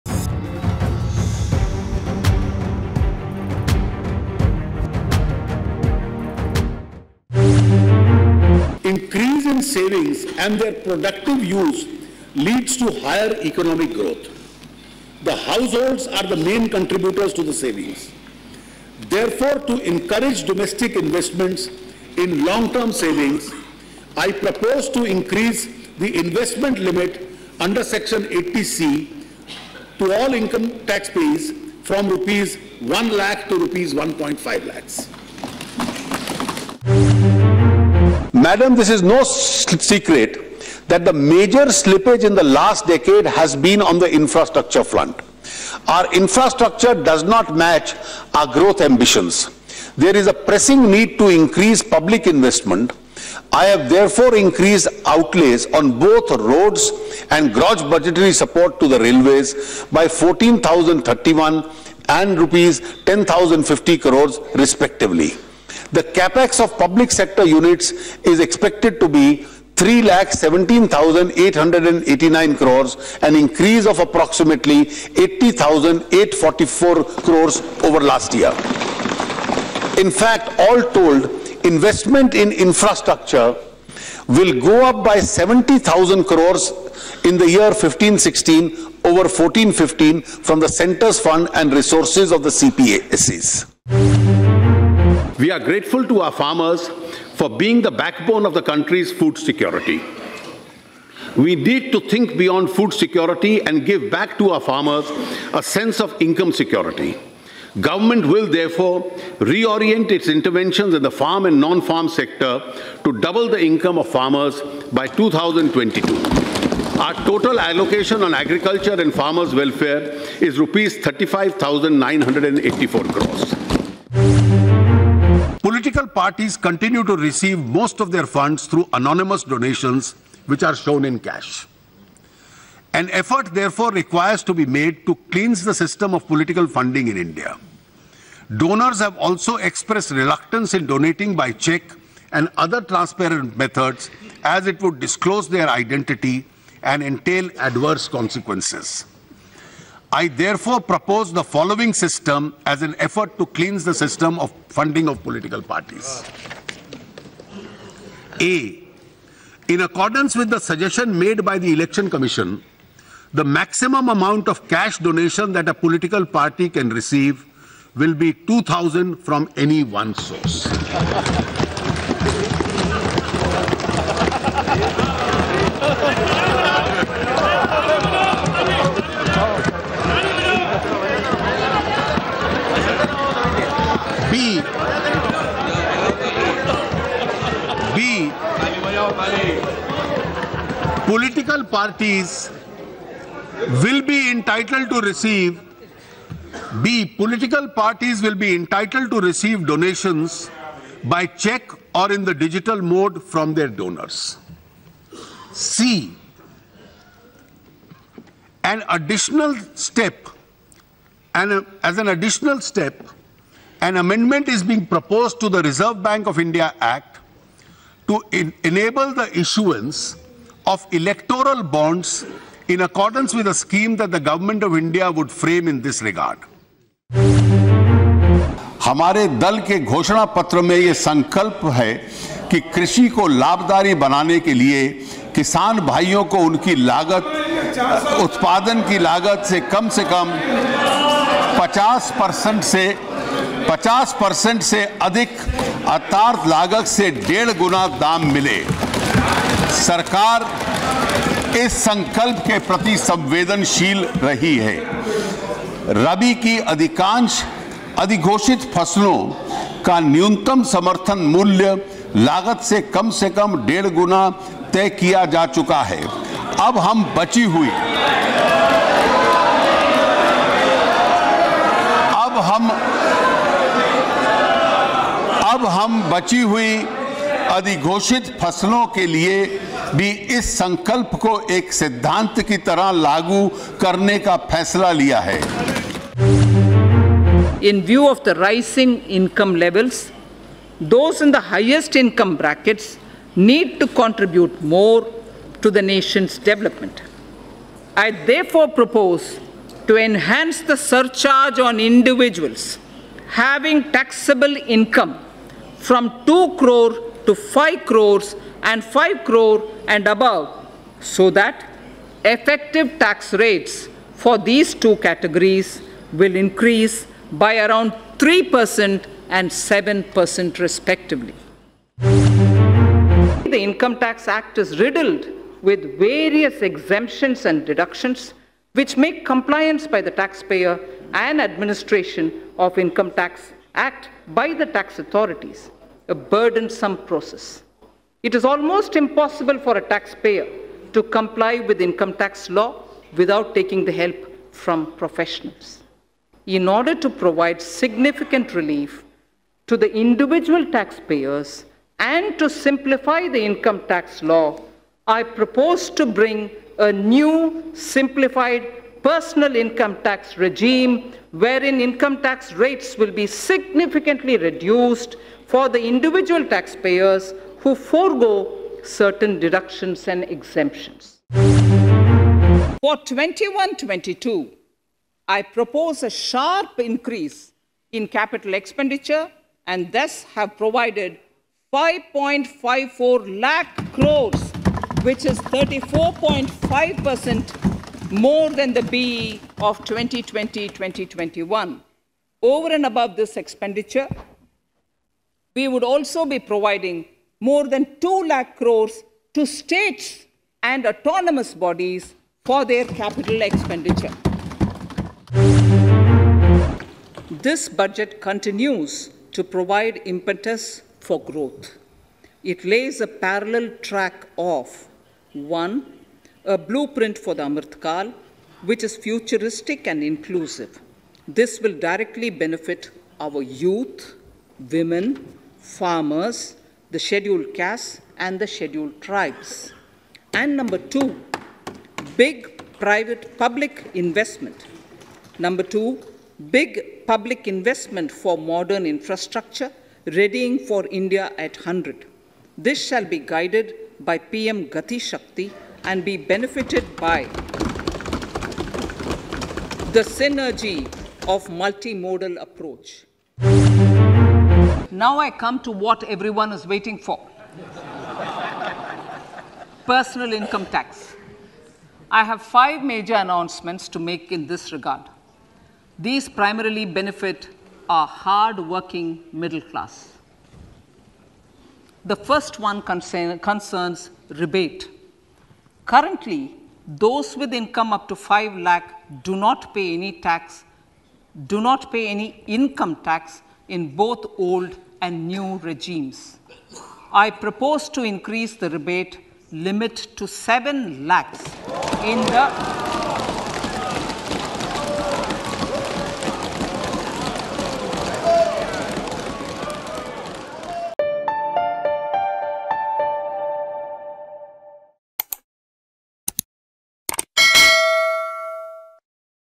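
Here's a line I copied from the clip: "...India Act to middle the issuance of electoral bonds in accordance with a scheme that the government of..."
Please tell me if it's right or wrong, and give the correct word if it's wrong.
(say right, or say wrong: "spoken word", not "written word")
wrong: "enable", not "middle".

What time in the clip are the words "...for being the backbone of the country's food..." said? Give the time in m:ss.
1:37.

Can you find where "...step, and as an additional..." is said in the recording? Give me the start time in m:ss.
3:29.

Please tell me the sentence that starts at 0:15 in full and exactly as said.
The households are the main contributors to the savings.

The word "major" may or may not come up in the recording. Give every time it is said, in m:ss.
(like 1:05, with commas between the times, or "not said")
0:41, 7:42.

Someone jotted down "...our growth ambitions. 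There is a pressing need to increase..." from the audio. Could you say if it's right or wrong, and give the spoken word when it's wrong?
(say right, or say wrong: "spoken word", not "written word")
right.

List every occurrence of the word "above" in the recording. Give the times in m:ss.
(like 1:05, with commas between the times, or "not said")
5:10, 6:32.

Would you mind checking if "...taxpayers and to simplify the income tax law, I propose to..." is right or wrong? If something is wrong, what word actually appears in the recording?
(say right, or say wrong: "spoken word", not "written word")
right.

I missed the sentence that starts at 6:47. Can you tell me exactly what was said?
This budget continues to provide impetus for growth.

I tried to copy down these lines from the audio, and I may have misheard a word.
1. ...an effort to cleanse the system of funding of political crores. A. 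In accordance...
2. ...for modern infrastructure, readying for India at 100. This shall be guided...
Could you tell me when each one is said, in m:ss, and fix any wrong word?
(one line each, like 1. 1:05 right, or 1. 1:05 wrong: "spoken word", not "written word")
1. 2:32 wrong: "parties", not "crores"
2. 7:18 right.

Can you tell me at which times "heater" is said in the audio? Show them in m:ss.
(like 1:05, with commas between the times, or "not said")
not said.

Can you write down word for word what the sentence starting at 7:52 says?
The first one concern, concerns rebate.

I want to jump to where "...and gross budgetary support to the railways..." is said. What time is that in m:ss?
0:57.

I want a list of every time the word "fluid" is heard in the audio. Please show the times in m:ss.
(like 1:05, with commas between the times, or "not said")
not said.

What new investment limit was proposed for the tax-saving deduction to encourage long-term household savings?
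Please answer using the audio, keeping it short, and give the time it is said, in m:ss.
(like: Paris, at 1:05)
1.5 lakhs, at 0:33.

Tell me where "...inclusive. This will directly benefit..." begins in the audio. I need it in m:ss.
7:00.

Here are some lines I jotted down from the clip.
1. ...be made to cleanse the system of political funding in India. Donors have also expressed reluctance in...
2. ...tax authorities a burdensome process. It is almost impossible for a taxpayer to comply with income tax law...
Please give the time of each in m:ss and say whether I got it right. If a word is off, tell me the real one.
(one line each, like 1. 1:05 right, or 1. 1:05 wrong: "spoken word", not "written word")
1. 2:14 right
2. 5:34 right.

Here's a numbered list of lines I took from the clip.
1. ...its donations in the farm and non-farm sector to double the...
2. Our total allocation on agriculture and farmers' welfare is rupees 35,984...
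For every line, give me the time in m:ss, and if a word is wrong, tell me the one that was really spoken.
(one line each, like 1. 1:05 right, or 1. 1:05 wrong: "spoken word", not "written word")
1. 1:50 wrong: "interventions", not "donations"
2. 1:57 right.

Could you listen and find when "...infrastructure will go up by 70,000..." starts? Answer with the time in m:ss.
1:22.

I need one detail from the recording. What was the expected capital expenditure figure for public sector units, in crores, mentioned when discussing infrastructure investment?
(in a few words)
3,17,889 crores.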